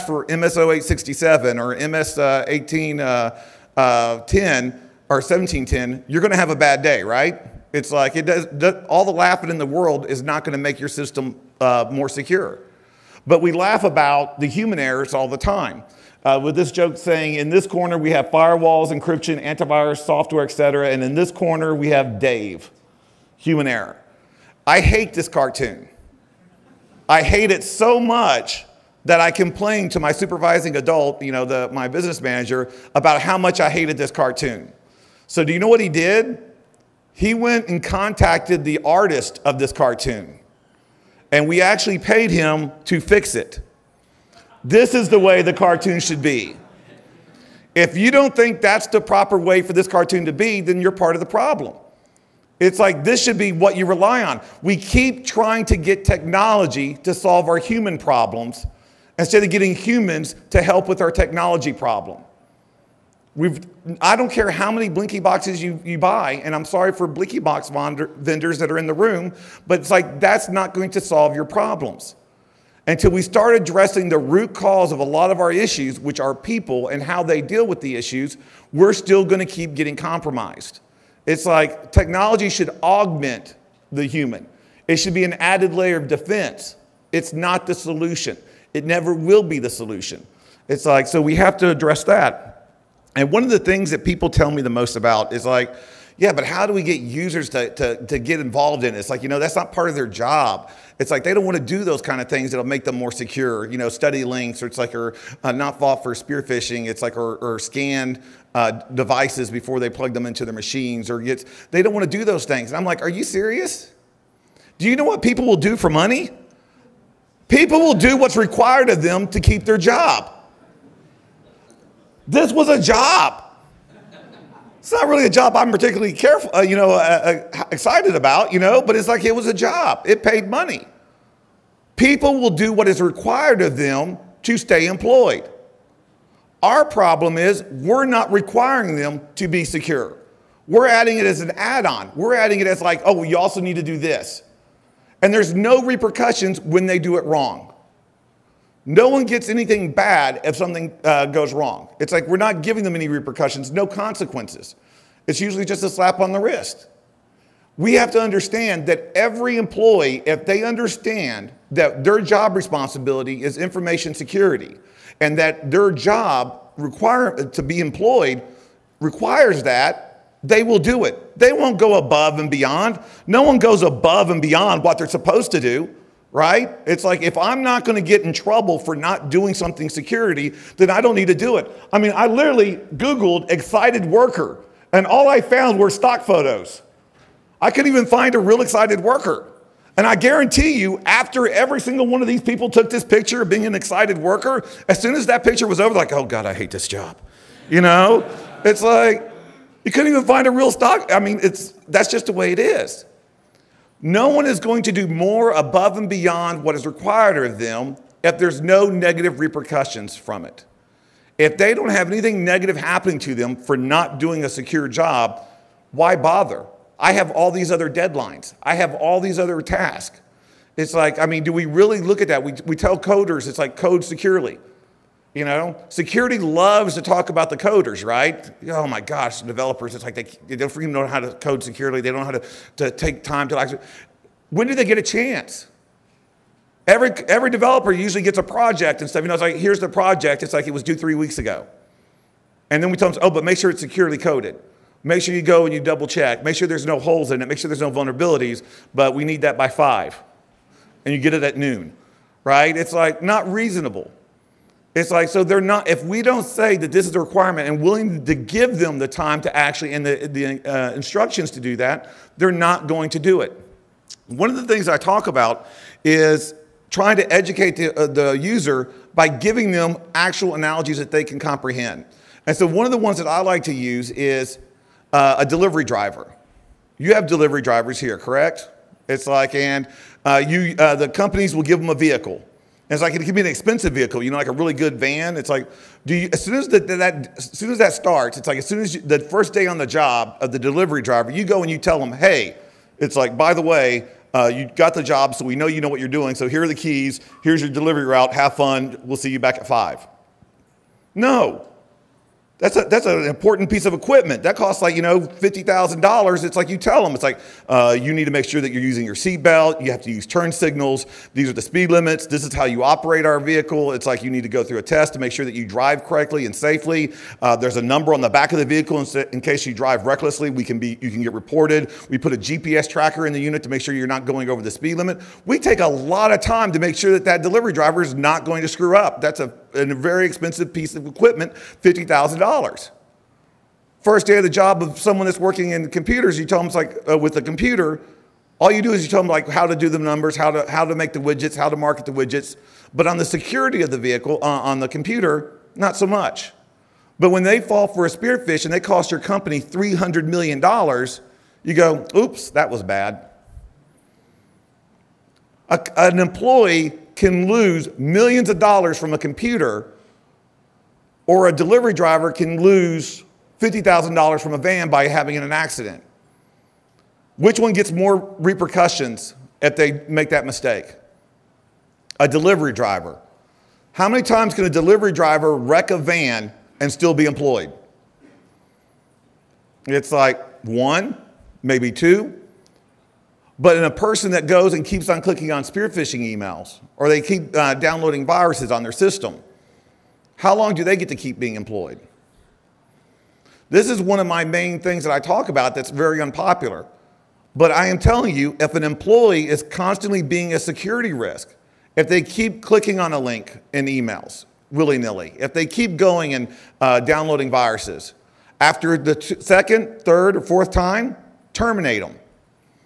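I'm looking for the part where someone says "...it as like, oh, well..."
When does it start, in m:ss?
2:22.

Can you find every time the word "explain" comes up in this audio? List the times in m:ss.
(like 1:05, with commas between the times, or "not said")
not said.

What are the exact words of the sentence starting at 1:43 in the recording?
You know, study links, or it's like, or uh, not fall for spear phishing.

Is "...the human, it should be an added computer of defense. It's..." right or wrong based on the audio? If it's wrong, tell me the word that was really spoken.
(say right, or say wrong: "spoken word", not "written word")
wrong: "layer", not "computer".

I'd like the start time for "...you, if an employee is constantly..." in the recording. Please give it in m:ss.
6:38.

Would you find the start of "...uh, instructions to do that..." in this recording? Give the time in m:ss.
4:20.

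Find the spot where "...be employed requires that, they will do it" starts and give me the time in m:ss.
2:47.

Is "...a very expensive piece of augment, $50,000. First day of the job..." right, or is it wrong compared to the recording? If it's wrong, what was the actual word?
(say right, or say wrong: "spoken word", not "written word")
wrong: "equipment", not "augment".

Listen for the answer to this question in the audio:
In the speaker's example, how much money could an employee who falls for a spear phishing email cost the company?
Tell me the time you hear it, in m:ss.
5:49.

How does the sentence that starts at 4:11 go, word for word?
And you get it at noon, right?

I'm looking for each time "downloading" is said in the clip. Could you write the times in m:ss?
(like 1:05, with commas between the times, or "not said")
6:27, 6:47.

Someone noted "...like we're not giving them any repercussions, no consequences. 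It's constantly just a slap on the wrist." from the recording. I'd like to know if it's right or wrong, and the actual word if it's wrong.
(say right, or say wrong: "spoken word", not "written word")
wrong: "usually", not "constantly".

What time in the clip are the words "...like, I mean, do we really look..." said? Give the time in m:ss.
3:40.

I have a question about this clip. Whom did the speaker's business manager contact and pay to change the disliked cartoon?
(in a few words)
The artist.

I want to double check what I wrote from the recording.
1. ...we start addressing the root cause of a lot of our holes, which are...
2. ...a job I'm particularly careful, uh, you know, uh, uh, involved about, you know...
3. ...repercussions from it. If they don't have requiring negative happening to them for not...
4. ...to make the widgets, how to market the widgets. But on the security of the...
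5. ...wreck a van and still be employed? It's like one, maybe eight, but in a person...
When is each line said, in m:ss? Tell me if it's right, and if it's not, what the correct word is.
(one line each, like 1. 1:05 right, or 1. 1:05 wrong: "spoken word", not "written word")
1. 1:13 wrong: "issues", not "holes"
2. 2:05 wrong: "excited", not "involved"
3. 3:29 wrong: "anything", not "requiring"
4. 5:40 right
5. 6:15 wrong: "two", not "eight".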